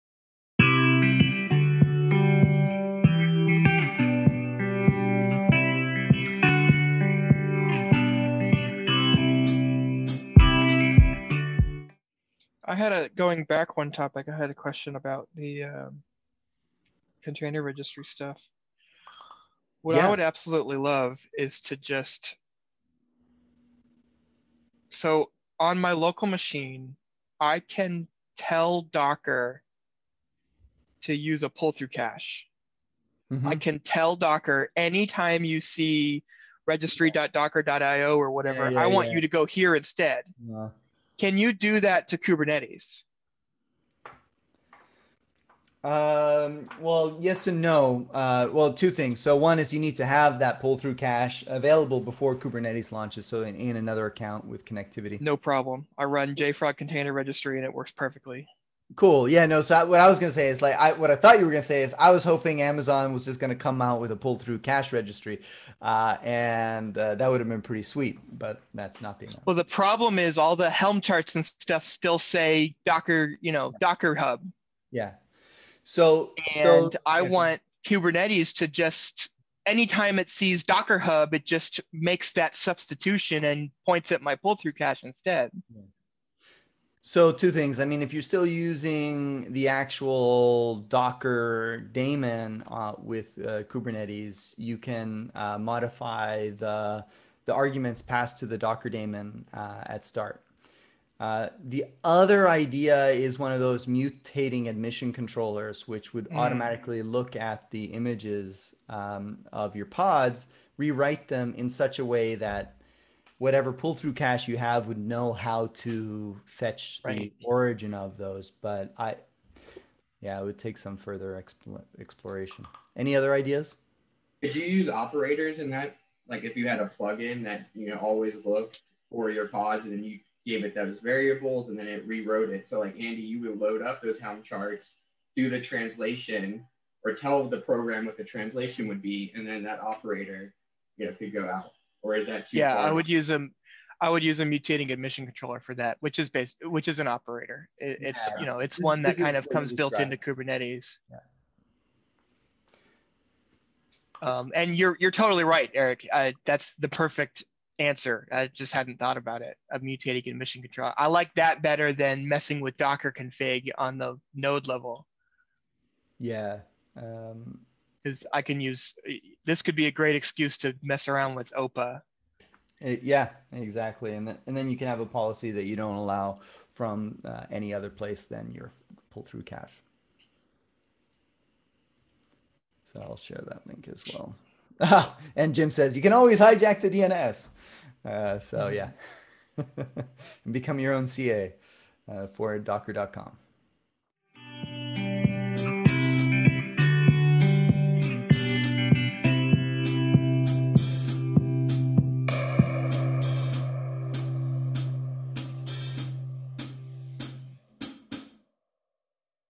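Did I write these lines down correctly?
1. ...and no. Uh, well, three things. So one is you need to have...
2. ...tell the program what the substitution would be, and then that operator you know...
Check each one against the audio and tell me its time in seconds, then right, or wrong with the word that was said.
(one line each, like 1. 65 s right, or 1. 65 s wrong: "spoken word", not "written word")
1. 47 s wrong: "two", not "three"
2. 137 s wrong: "translation", not "substitution".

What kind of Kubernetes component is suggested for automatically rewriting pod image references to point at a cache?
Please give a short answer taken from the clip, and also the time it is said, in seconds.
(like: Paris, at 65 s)
mutating admission controller, at 103 s.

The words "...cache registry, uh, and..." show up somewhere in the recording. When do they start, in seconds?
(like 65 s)
64 s.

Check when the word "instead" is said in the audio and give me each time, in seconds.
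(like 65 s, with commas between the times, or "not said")
39 s, 85 s.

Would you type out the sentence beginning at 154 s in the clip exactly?
Um, and you're you're totally right, Eric.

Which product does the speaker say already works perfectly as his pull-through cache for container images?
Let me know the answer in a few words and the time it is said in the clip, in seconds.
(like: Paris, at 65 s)
JFrog container registry, at 56 s.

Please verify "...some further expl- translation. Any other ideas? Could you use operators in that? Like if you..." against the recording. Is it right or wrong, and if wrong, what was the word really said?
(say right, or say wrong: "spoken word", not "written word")
wrong: "exploration", not "translation".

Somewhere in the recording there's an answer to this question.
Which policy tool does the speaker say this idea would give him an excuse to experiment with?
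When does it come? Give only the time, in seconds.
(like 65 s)
171 s.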